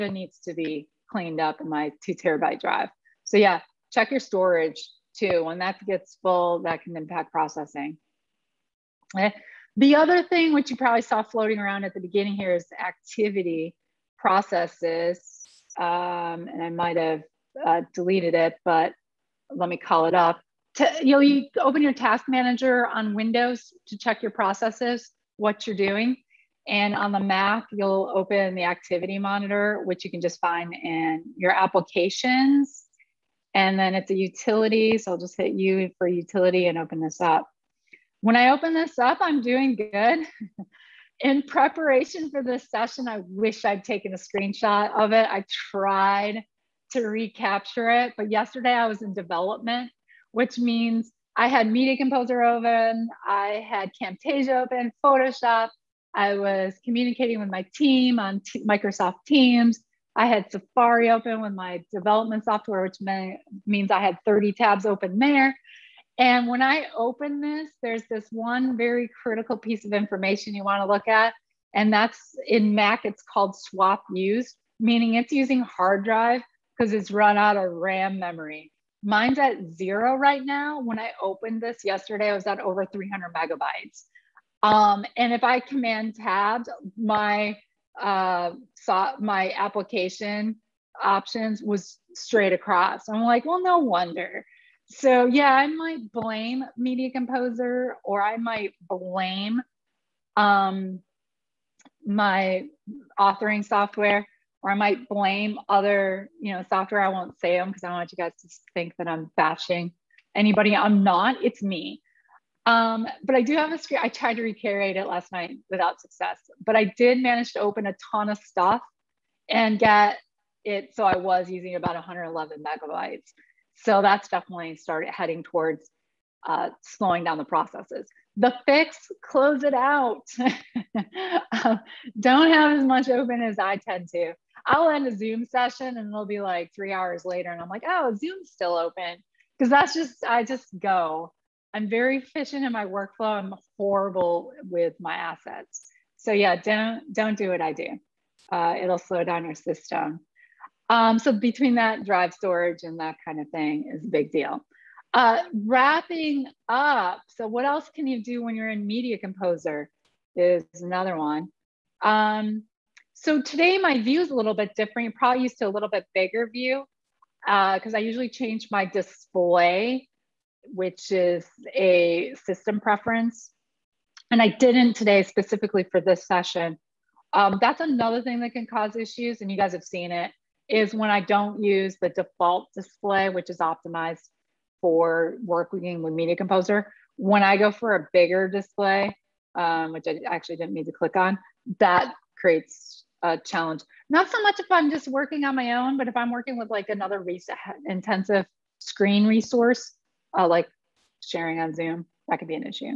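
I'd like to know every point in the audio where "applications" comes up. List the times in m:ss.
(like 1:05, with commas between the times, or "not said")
0:31, 1:29.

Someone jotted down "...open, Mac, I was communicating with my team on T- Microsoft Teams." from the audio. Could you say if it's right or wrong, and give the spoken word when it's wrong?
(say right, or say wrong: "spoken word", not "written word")
wrong: "Photoshop", not "Mac".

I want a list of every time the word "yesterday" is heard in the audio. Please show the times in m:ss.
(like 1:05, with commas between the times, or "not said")
0:48, 1:21.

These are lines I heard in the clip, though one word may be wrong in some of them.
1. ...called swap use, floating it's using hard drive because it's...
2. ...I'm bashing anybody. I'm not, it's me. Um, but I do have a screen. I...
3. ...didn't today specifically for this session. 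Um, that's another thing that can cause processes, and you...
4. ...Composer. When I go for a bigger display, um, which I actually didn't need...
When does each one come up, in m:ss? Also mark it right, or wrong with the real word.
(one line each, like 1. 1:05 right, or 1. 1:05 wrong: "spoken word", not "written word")
1. 1:13 wrong: "meaning", not "floating"
2. 1:49 right
3. 2:54 wrong: "issues", not "processes"
4. 3:06 right.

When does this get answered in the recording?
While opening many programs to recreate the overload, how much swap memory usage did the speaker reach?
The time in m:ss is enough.
2:01.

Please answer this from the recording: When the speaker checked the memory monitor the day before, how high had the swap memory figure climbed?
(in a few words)
over 300 megabytes.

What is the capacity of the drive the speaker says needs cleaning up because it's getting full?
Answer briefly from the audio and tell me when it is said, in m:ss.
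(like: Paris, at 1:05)
2 terabytes, at 0:02.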